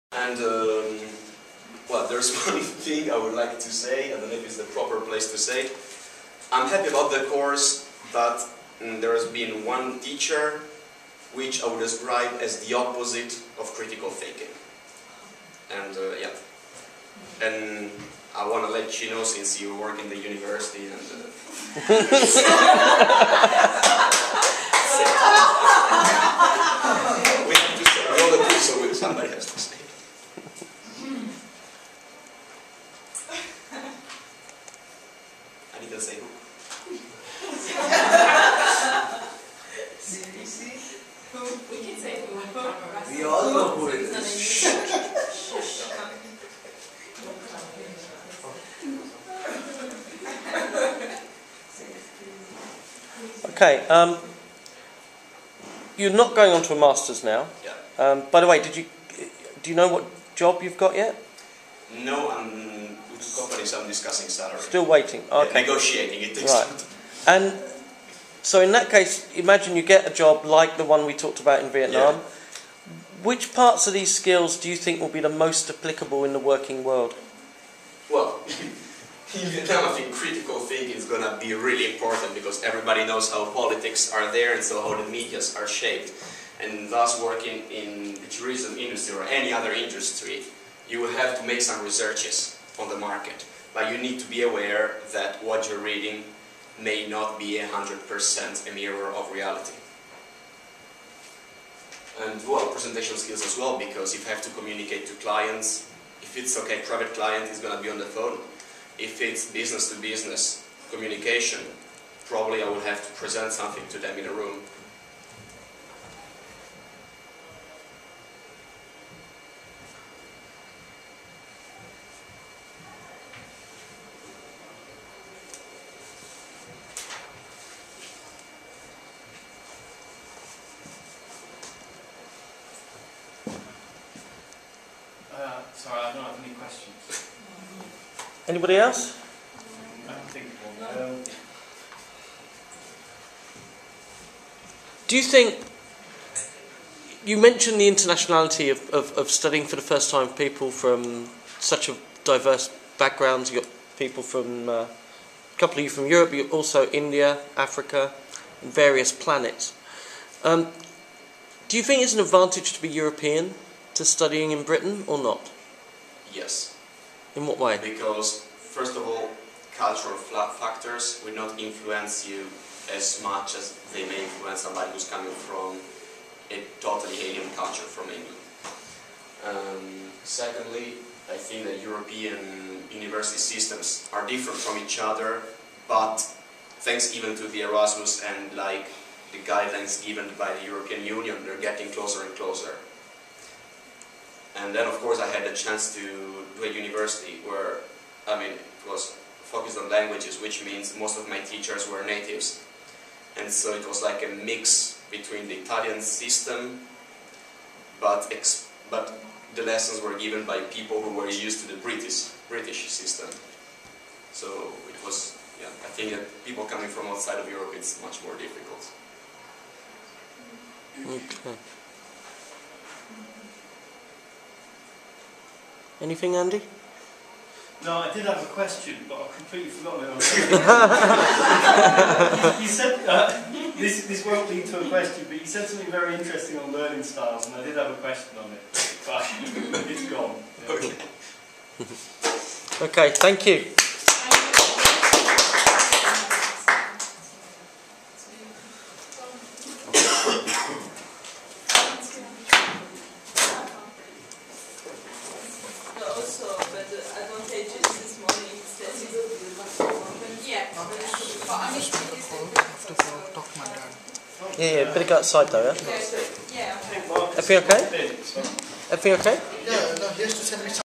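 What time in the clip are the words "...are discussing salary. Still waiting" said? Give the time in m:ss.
1:03.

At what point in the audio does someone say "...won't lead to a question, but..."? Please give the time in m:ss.
3:54.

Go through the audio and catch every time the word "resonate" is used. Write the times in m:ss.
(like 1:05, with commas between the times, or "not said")
not said.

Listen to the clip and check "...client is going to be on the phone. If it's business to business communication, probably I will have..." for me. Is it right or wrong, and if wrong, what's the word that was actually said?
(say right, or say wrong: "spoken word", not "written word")
right.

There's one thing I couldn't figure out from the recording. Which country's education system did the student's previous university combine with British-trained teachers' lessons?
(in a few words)
Italian.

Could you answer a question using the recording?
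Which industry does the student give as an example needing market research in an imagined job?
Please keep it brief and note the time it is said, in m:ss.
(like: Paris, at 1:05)
tourism, at 1:28.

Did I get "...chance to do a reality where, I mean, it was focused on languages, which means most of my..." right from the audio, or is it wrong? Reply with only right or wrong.
wrong.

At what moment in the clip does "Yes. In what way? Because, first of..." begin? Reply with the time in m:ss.
2:46.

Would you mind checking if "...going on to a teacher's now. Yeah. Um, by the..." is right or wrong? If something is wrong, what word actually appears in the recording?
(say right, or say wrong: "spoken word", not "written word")
wrong: "master", not "teacher".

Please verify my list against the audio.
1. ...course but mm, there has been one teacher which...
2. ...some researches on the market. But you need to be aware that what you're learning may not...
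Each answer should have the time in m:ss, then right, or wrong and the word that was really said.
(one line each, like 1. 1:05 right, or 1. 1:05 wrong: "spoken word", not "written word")
1. 0:07 right
2. 1:31 wrong: "reading", not "learning".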